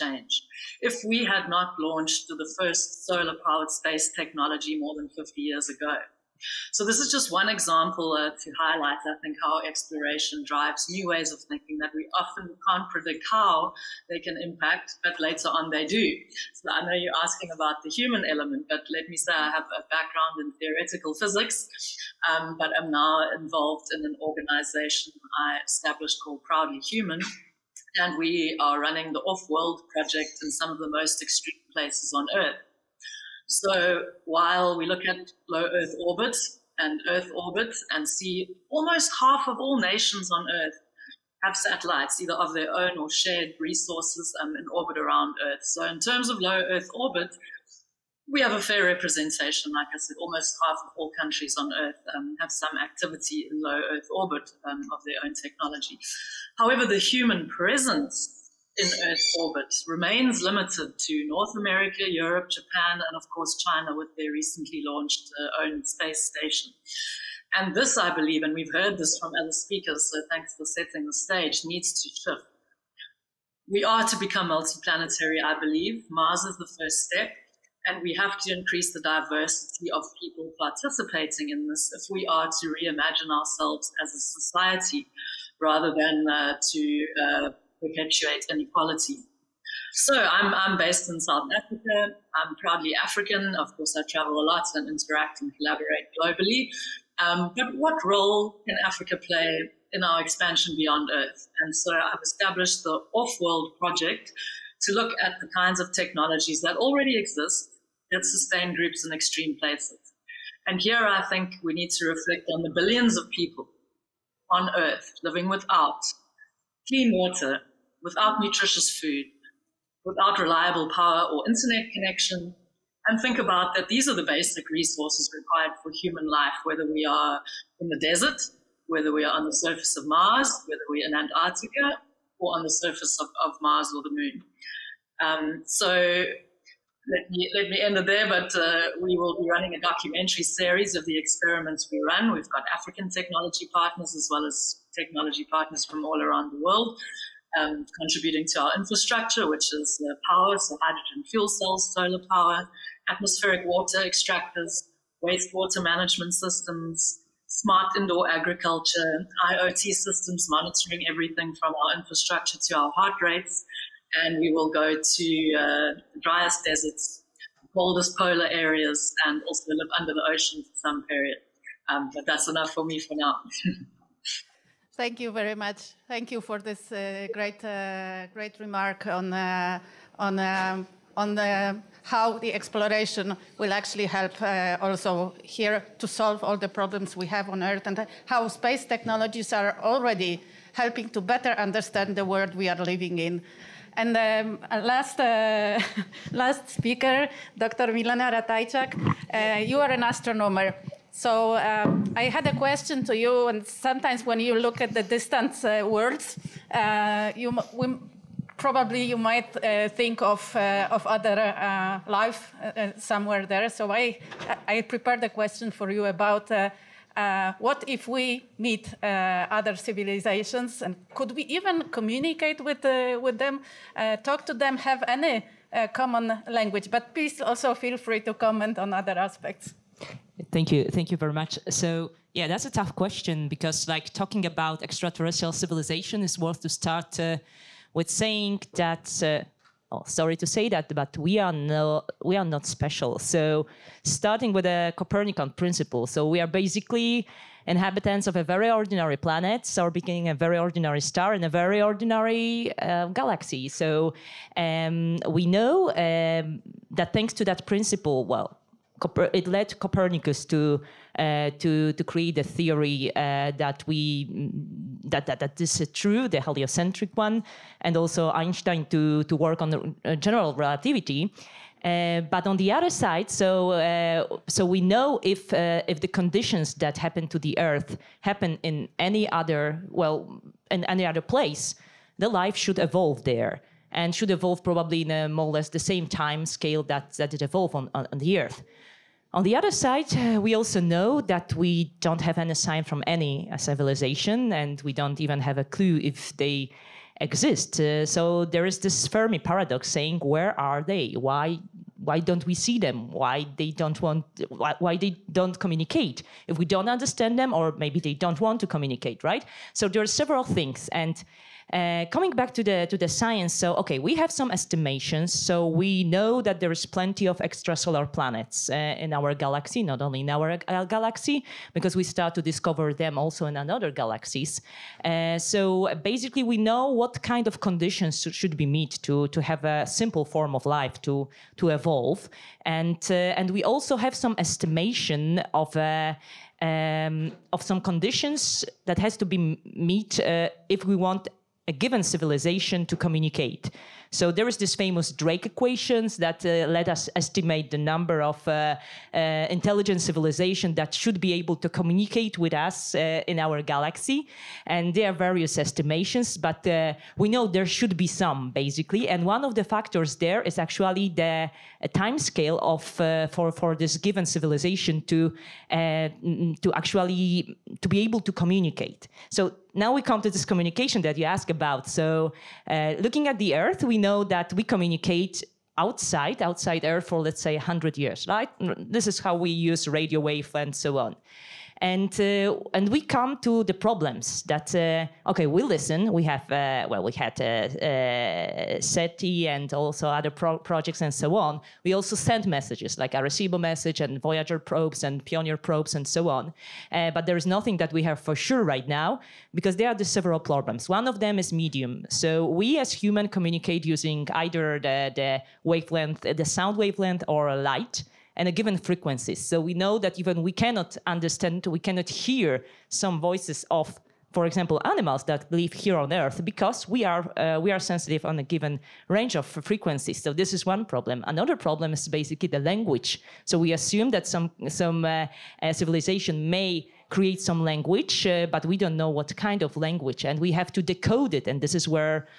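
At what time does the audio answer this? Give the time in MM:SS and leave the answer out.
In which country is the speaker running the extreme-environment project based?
01:31.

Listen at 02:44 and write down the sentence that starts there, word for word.
And we will go to uh, driest deserts, coldest polar areas, and also live under the ocean for some period.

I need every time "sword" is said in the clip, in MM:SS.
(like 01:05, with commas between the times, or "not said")
not said.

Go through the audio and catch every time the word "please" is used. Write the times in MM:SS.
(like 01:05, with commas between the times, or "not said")
03:47.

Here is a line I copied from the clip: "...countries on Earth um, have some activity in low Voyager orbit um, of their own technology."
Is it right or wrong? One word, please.
wrong.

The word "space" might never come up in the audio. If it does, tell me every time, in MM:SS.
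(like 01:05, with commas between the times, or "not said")
00:03, 01:05, 03:08.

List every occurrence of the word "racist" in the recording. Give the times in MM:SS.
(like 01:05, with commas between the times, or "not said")
not said.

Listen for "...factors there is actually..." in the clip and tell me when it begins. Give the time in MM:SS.
05:59.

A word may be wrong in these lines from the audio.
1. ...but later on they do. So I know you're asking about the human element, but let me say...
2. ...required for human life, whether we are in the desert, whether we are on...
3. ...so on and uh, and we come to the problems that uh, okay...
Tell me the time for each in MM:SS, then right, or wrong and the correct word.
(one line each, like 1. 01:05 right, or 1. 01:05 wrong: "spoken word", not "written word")
1. 00:15 right
2. 02:05 right
3. 06:20 right.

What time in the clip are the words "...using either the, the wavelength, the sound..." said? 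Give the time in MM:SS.
06:43.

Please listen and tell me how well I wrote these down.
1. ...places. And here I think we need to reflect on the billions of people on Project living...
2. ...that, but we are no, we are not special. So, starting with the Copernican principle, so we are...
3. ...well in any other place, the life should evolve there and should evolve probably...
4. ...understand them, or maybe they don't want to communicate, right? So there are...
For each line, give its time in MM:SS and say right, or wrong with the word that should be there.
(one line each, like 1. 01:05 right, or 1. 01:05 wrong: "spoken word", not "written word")
1. 01:49 wrong: "Earth", not "Project"
2. 04:00 right
3. 04:39 right
4. 05:06 right.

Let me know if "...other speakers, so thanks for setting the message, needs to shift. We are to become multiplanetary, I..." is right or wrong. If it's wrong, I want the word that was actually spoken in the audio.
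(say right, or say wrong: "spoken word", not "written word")
wrong: "stage", not "message".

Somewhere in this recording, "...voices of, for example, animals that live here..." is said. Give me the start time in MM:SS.
06:53.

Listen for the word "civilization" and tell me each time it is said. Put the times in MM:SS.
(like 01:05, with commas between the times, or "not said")
03:39, 03:55, 04:53, 05:42, 05:50, 06:04, 07:05.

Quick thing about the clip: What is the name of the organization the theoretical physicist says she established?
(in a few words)
Proudly Human.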